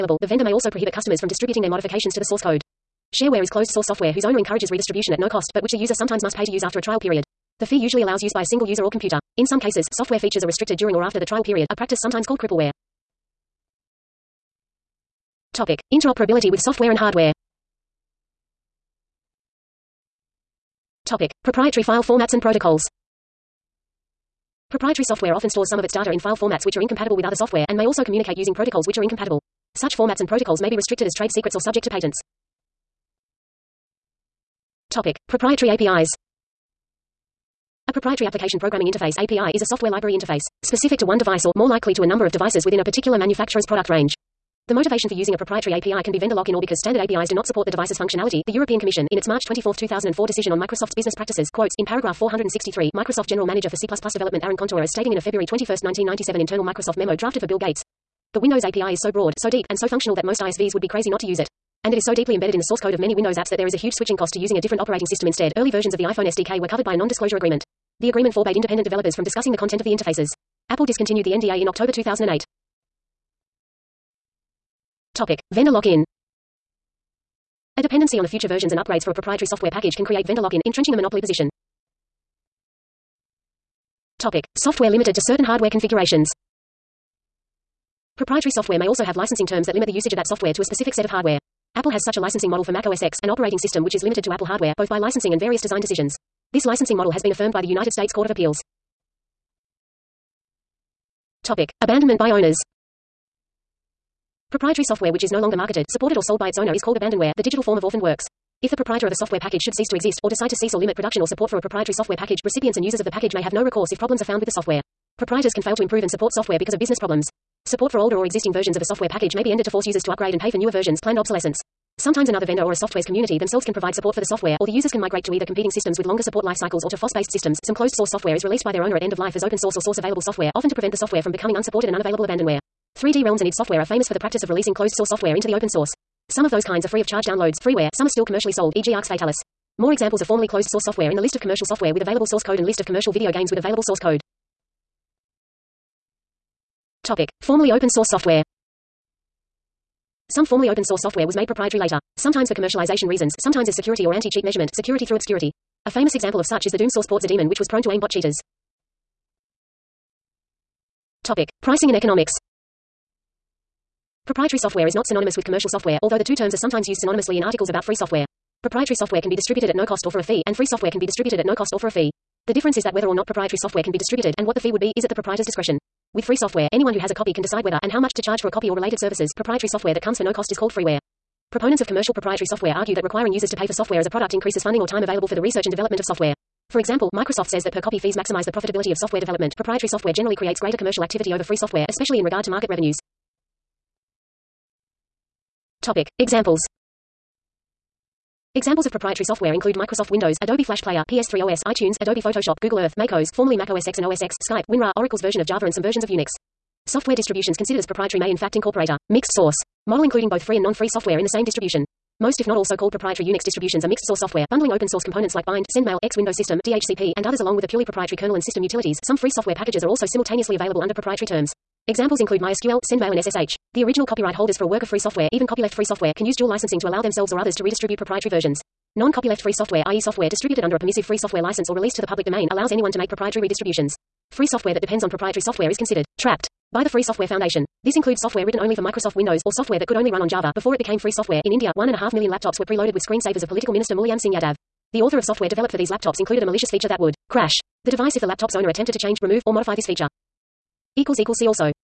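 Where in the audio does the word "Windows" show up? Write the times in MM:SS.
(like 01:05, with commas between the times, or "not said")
00:58, 01:03, 03:20, 03:36, 03:59.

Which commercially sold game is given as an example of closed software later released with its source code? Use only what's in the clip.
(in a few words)
Arx Fatalis.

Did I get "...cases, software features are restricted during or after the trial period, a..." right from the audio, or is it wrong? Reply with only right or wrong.
right.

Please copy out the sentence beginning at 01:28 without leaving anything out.
Proprietary software may also have licensing terms that limit the usage of that software to a specific set of hardware.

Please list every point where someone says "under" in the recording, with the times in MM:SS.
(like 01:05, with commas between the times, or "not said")
03:40, 03:50.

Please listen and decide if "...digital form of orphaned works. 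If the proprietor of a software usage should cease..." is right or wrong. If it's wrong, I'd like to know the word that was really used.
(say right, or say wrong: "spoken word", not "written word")
wrong: "package", not "usage".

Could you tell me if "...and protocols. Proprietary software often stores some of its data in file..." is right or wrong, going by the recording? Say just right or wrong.
right.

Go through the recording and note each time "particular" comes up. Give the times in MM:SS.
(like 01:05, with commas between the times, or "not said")
00:42.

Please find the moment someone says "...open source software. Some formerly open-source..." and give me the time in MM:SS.
02:27.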